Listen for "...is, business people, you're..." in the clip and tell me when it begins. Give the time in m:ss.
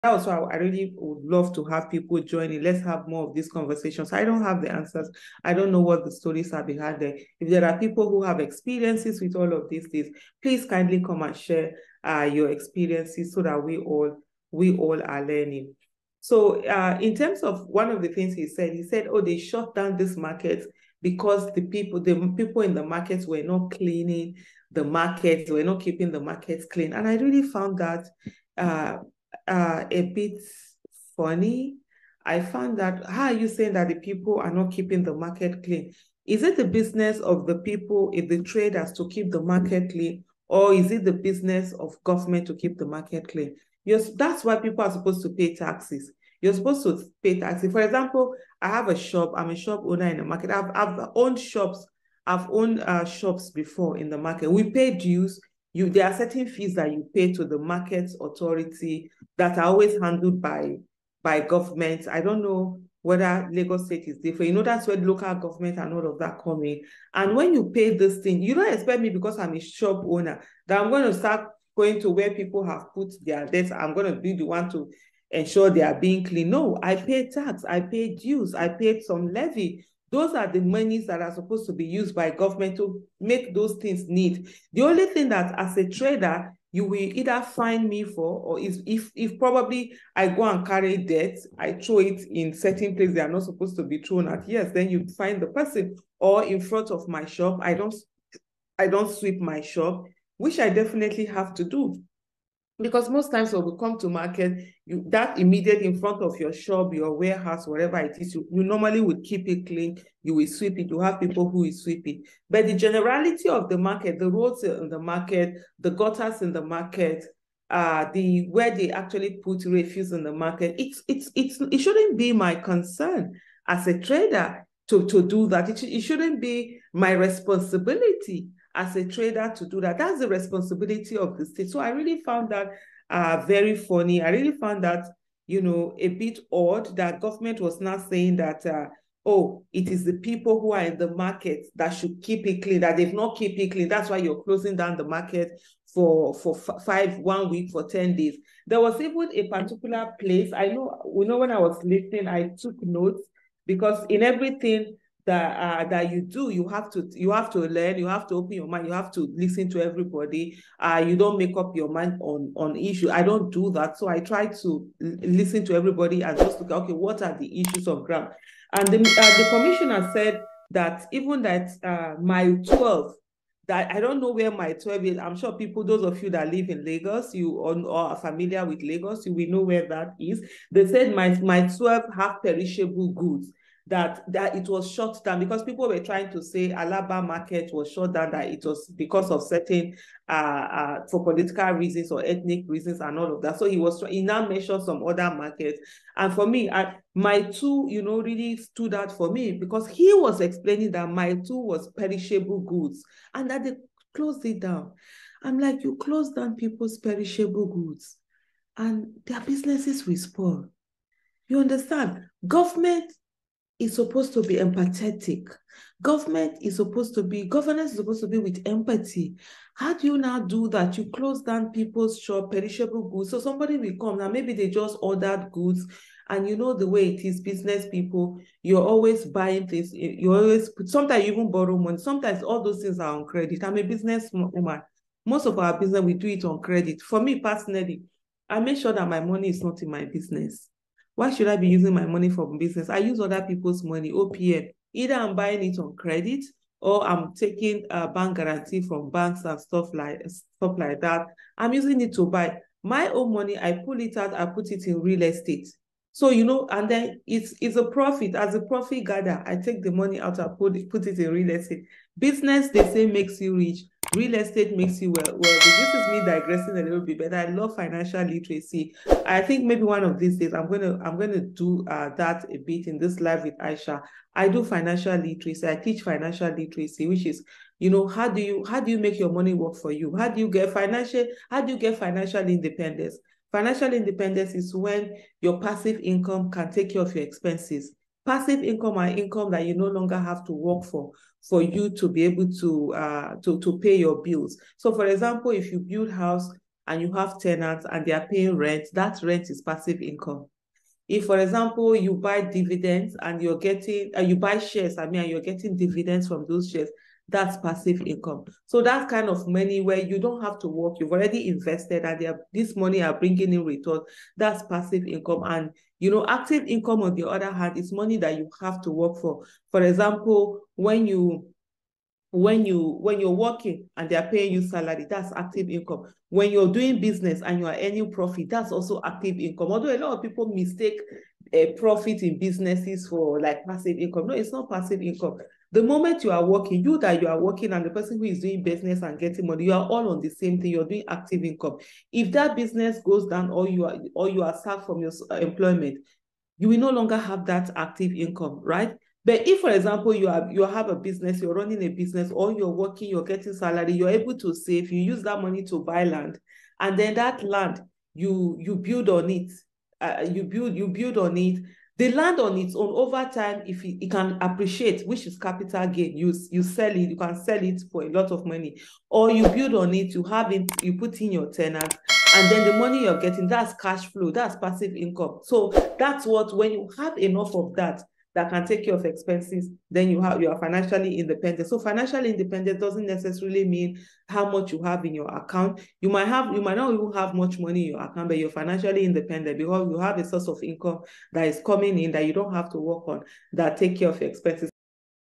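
3:47.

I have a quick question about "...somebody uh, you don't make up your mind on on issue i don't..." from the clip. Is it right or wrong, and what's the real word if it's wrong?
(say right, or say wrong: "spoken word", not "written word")
wrong: "everybody", not "somebody".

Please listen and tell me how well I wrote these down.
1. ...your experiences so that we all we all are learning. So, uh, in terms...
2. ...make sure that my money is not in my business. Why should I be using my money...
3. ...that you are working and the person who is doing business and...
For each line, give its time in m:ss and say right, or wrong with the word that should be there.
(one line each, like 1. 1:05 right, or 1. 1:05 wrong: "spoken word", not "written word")
1. 0:12 right
2. 3:58 right
3. 5:36 right.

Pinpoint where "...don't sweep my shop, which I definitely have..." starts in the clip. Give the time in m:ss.
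1:38.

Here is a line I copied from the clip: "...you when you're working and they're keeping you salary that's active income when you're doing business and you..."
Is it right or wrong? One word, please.
wrong.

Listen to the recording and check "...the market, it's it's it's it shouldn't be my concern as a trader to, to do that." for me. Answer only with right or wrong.
right.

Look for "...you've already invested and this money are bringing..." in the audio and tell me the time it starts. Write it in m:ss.
5:10.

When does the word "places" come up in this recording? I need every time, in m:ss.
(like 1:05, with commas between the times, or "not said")
1:32, 2:30.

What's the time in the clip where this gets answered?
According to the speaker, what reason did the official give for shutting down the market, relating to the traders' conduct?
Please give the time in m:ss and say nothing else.
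0:25.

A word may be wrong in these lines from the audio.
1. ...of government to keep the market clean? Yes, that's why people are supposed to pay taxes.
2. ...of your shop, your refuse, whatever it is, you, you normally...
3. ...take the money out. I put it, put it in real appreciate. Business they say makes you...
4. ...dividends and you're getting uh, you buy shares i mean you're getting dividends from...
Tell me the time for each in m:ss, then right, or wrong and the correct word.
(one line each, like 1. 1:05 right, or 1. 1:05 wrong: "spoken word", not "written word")
1. 0:41 right
2. 1:46 wrong: "warehouse", not "refuse"
3. 4:19 wrong: "estate", not "appreciate"
4. 5:02 right.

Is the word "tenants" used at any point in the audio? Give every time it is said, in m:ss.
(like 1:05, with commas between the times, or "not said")
4:57, 6:11.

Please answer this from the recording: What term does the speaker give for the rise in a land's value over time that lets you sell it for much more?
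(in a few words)
capital gain.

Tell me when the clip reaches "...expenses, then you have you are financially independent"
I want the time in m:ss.
6:19.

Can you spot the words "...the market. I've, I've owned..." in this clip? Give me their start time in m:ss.
0:50.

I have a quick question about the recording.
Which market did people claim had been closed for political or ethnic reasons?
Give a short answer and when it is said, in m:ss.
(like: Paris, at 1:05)
Alaba market, at 3:06.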